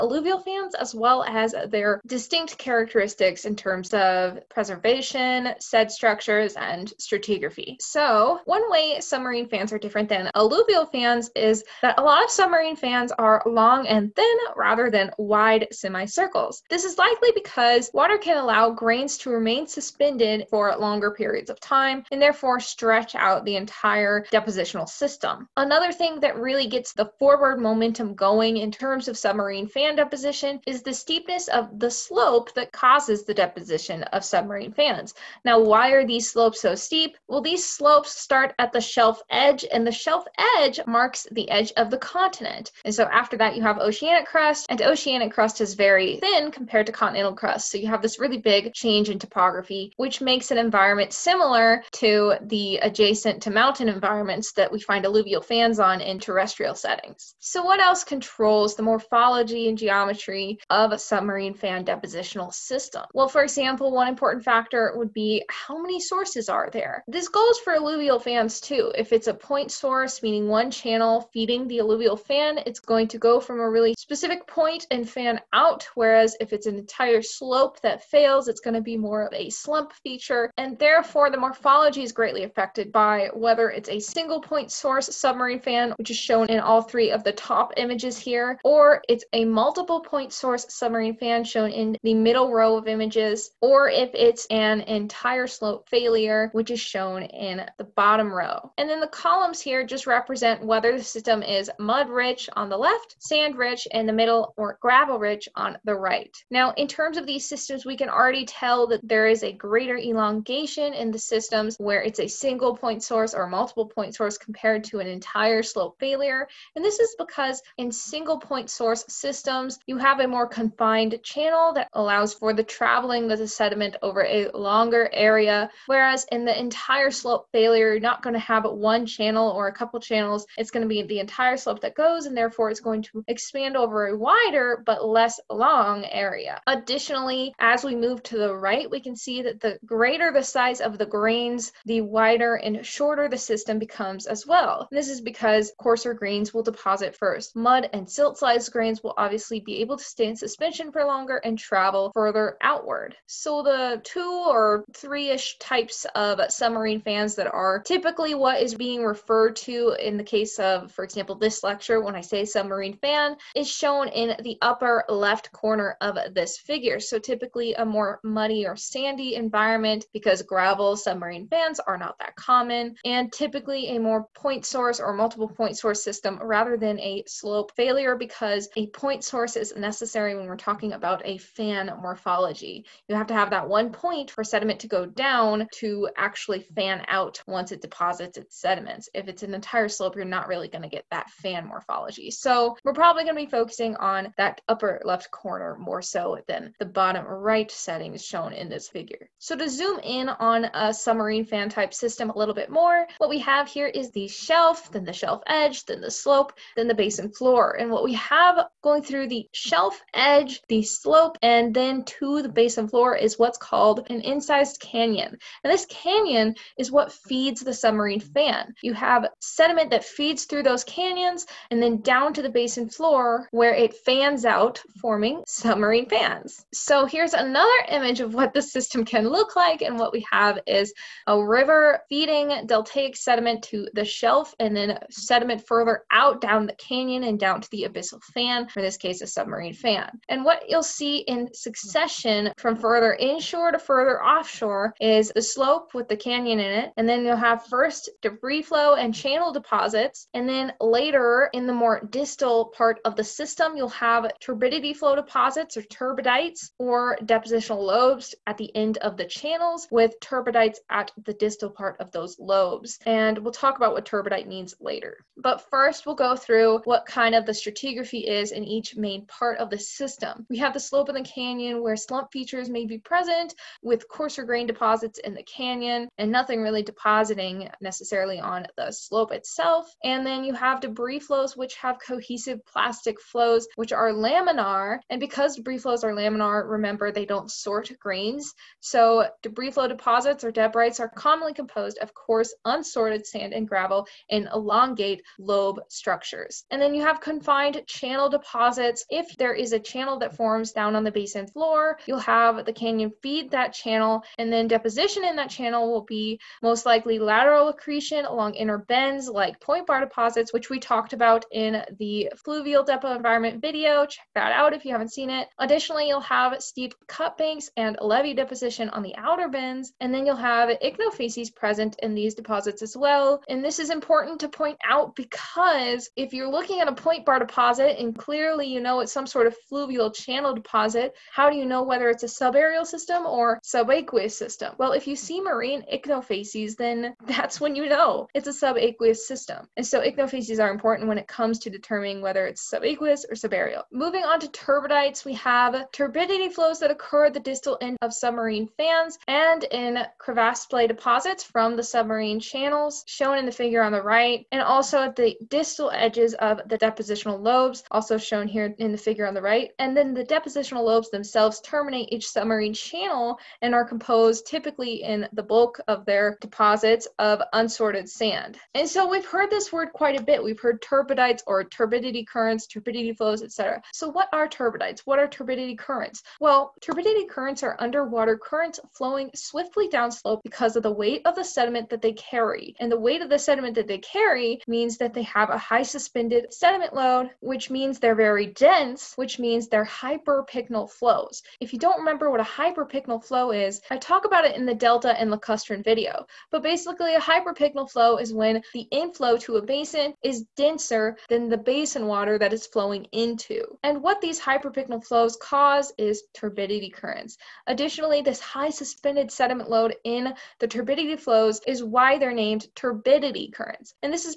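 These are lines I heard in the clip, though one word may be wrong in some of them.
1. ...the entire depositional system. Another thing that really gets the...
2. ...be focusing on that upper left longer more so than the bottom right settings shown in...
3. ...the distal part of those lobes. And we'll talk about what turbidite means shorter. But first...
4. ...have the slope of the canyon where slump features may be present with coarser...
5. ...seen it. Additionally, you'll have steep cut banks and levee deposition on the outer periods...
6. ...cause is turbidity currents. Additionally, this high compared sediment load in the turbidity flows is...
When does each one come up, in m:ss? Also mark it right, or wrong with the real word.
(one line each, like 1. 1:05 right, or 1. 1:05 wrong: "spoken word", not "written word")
1. 0:23 right
2. 3:13 wrong: "corner", not "longer"
3. 4:21 wrong: "later", not "shorter"
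4. 4:30 right
5. 5:15 wrong: "bends", not "periods"
6. 6:45 wrong: "suspended", not "compared".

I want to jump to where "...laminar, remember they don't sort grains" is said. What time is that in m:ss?
4:46.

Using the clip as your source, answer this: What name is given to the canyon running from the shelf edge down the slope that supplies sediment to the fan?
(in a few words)
inside sized canyon.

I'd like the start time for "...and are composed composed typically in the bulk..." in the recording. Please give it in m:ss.
6:03.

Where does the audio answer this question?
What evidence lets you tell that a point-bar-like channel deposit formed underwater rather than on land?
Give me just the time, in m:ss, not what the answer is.
5:35.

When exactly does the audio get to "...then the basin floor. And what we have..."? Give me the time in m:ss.
3:26.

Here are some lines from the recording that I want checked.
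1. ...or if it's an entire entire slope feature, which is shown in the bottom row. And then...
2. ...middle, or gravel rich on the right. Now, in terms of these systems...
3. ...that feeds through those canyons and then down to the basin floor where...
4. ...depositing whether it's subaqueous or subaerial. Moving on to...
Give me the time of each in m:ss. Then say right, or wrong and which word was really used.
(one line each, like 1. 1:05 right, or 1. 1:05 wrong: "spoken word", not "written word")
1. 1:33 wrong: "failure", not "feature"
2. 1:44 right
3. 3:39 right
4. 5:41 wrong: "determining", not "depositing".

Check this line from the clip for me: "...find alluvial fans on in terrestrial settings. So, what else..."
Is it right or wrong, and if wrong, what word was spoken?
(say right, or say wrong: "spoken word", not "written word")
right.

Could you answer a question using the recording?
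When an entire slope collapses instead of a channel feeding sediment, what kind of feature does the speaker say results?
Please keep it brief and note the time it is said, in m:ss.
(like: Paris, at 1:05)
slump feature, at 1:19.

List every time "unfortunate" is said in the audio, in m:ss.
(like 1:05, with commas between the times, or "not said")
not said.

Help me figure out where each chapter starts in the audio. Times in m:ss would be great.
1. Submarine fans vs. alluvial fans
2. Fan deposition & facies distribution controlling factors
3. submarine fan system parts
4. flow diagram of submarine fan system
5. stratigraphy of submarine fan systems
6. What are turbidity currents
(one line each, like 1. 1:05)
1. 0:08
2. 0:57
3. 3:19
4. 3:46
5. 4:25
6. 6:09.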